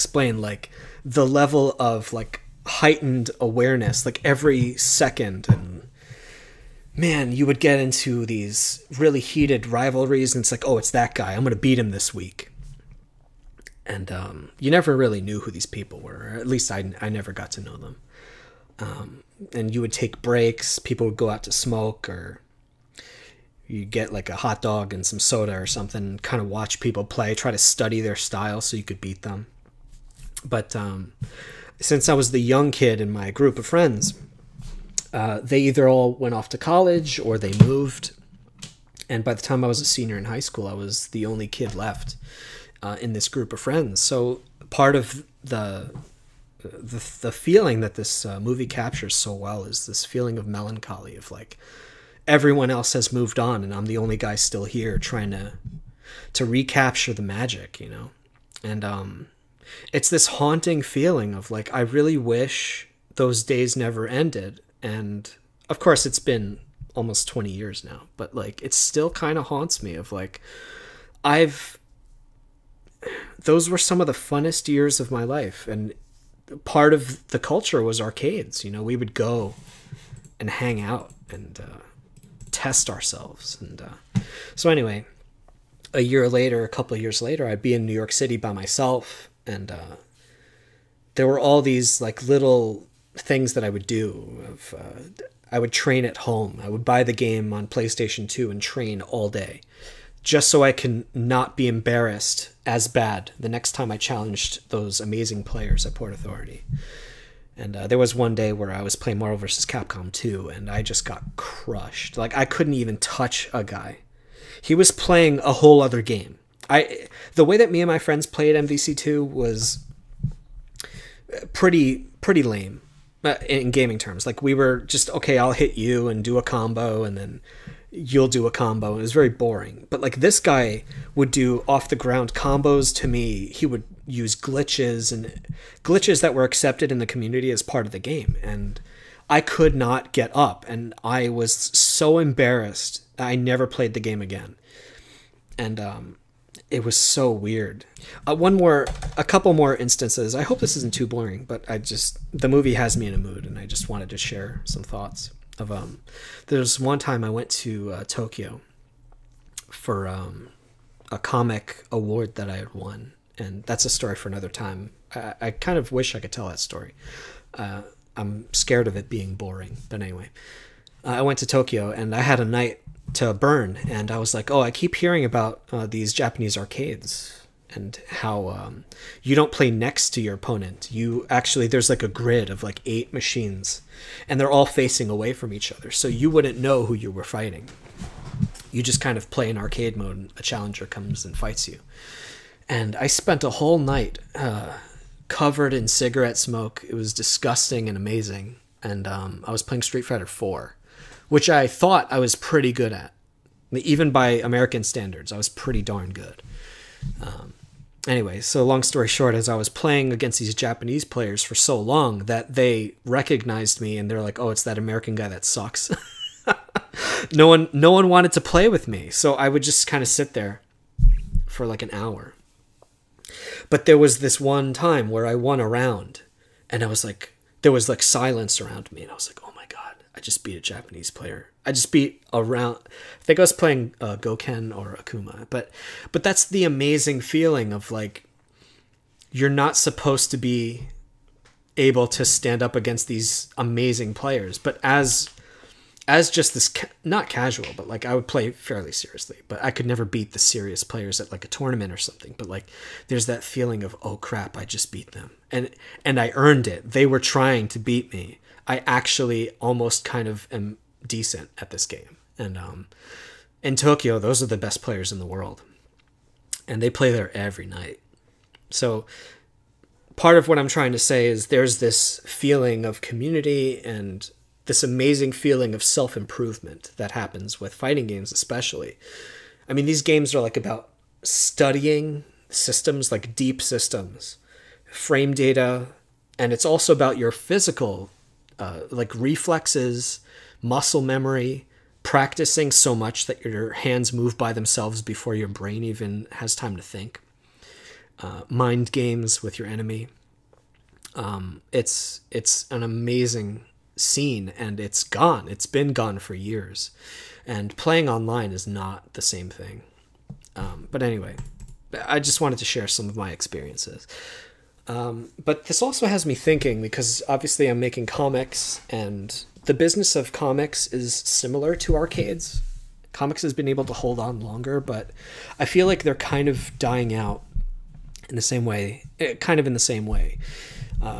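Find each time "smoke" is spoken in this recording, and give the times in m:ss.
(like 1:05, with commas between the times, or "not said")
0:21, 3:16.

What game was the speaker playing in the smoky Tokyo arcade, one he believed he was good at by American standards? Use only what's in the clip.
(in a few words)
Street Fighter 4.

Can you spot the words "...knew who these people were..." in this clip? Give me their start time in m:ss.
0:15.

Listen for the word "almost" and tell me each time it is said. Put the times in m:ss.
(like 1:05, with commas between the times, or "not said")
1:06, 4:19.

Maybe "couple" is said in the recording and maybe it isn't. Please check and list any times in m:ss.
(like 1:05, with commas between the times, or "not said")
1:26, 2:29.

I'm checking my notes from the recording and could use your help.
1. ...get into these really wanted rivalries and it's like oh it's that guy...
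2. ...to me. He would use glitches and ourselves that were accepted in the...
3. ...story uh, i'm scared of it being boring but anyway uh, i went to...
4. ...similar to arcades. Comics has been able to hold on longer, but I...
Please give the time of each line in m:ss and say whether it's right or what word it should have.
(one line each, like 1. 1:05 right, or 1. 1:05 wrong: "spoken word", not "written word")
1. 0:07 wrong: "heated", not "wanted"
2. 2:12 wrong: "glitches", not "ourselves"
3. 2:46 right
4. 5:21 right.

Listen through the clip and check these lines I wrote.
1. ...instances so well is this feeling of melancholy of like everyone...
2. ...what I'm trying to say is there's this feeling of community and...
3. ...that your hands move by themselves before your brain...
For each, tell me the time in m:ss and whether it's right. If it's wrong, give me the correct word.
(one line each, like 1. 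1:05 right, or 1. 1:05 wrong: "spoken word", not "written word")
1. 0:48 wrong: "captures", not "instances"
2. 4:30 right
3. 4:53 right.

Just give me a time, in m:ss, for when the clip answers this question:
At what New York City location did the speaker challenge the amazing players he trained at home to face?
1:45.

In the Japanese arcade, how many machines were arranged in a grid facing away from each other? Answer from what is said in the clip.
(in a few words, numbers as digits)
8.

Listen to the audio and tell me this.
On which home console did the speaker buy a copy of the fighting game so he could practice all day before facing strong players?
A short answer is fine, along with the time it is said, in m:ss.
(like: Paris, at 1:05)
PlayStation 2, at 1:37.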